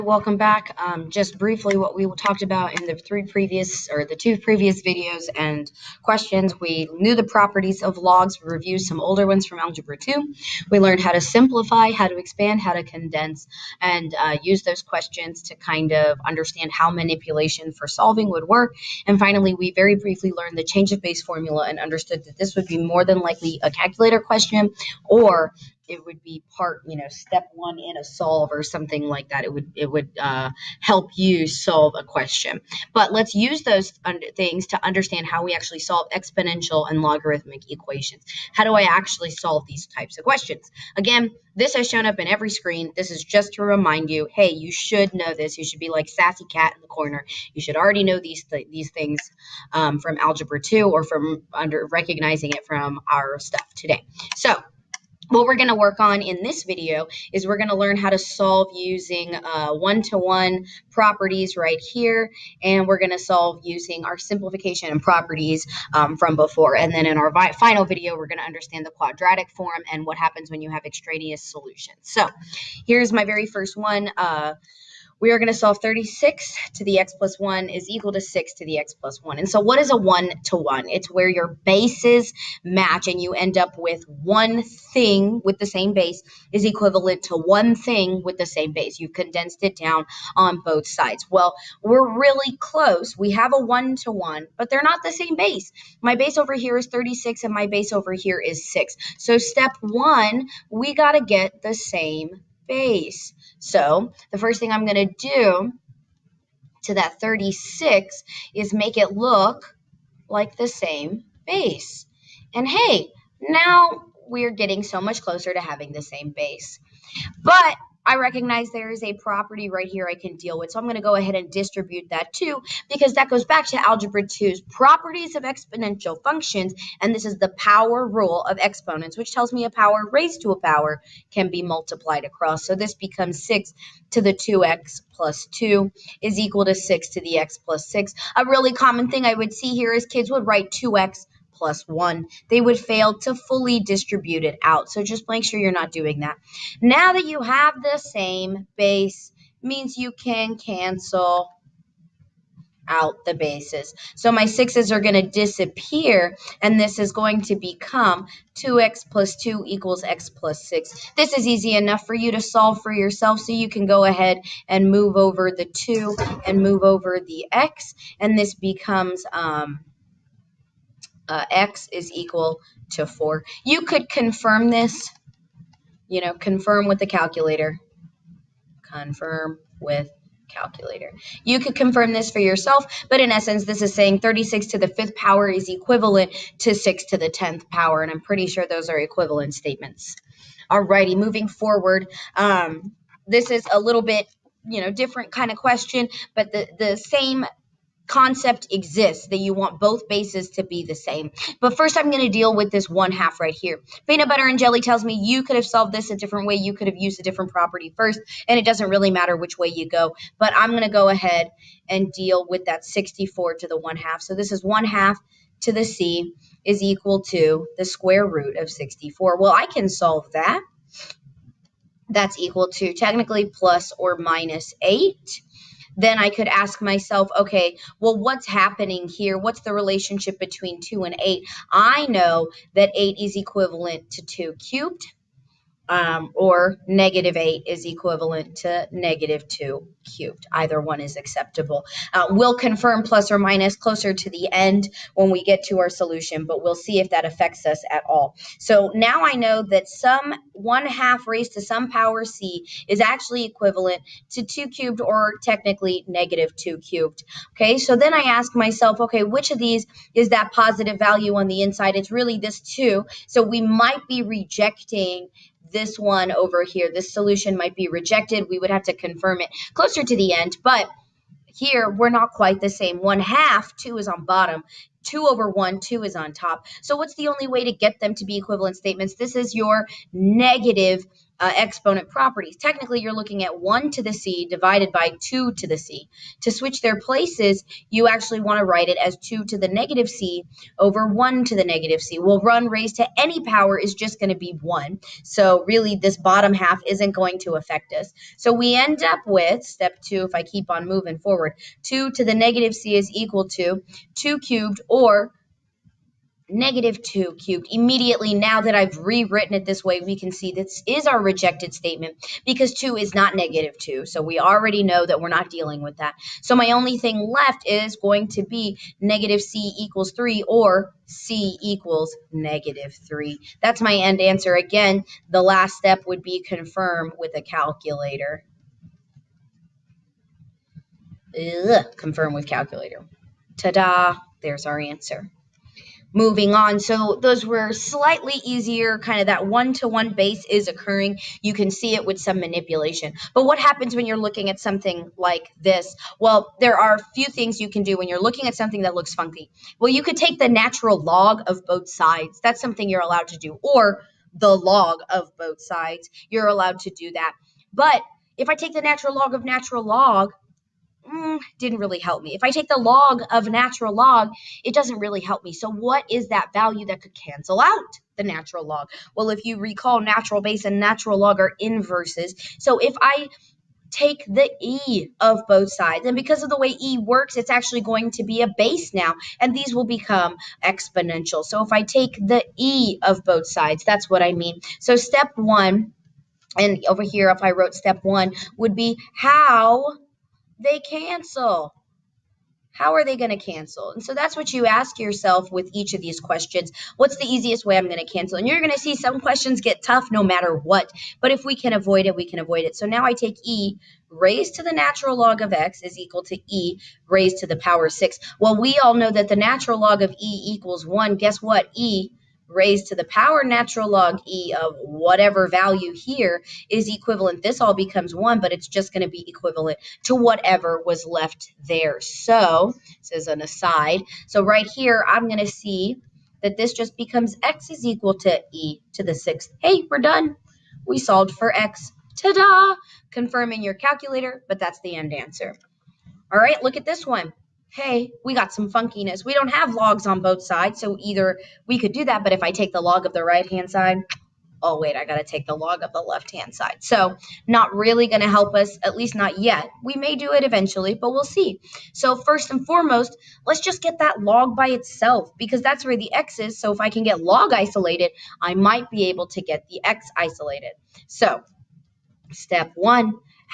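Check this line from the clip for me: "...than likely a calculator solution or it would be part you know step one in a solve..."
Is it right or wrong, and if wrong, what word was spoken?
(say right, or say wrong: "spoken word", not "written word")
wrong: "question", not "solution".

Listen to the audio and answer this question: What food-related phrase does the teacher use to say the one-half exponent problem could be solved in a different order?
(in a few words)
Peanut butter and jelly.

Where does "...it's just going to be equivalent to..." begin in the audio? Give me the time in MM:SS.
06:58.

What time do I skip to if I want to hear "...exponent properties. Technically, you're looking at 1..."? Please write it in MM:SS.
04:41.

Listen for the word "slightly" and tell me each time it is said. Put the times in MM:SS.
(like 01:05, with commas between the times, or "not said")
05:37.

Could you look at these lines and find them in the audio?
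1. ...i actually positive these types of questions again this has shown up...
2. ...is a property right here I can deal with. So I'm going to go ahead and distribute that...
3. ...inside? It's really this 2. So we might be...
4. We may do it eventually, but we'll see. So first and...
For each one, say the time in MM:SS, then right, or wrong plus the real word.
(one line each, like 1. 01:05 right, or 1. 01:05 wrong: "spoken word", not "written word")
1. 00:38 wrong: "solve", not "positive"
2. 01:58 right
3. 04:21 right
4. 07:29 right.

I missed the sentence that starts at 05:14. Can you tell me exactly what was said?
So we already know that we're not dealing with that.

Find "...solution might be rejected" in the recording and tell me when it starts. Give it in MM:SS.
04:27.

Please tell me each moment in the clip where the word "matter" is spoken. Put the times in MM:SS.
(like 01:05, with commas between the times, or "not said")
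03:29, 06:40.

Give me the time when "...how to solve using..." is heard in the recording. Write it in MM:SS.
00:57.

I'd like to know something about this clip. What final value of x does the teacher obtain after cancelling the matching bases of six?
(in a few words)
4.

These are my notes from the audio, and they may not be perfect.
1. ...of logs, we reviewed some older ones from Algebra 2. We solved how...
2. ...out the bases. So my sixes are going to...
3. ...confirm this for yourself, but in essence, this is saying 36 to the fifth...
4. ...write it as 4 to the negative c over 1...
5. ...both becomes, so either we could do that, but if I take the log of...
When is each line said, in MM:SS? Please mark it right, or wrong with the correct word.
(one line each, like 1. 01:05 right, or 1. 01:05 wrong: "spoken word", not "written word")
1. 00:07 wrong: "learned", not "solved"
2. 02:32 right
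3. 03:01 right
4. 04:48 wrong: "2", not "4"
5. 07:20 wrong: "sides", not "becomes".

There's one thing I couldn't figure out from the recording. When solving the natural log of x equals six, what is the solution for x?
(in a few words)
e to the sixth.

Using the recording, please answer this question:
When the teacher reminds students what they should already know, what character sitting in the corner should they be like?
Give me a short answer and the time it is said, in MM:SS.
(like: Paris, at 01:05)
sassy cat, at 00:46.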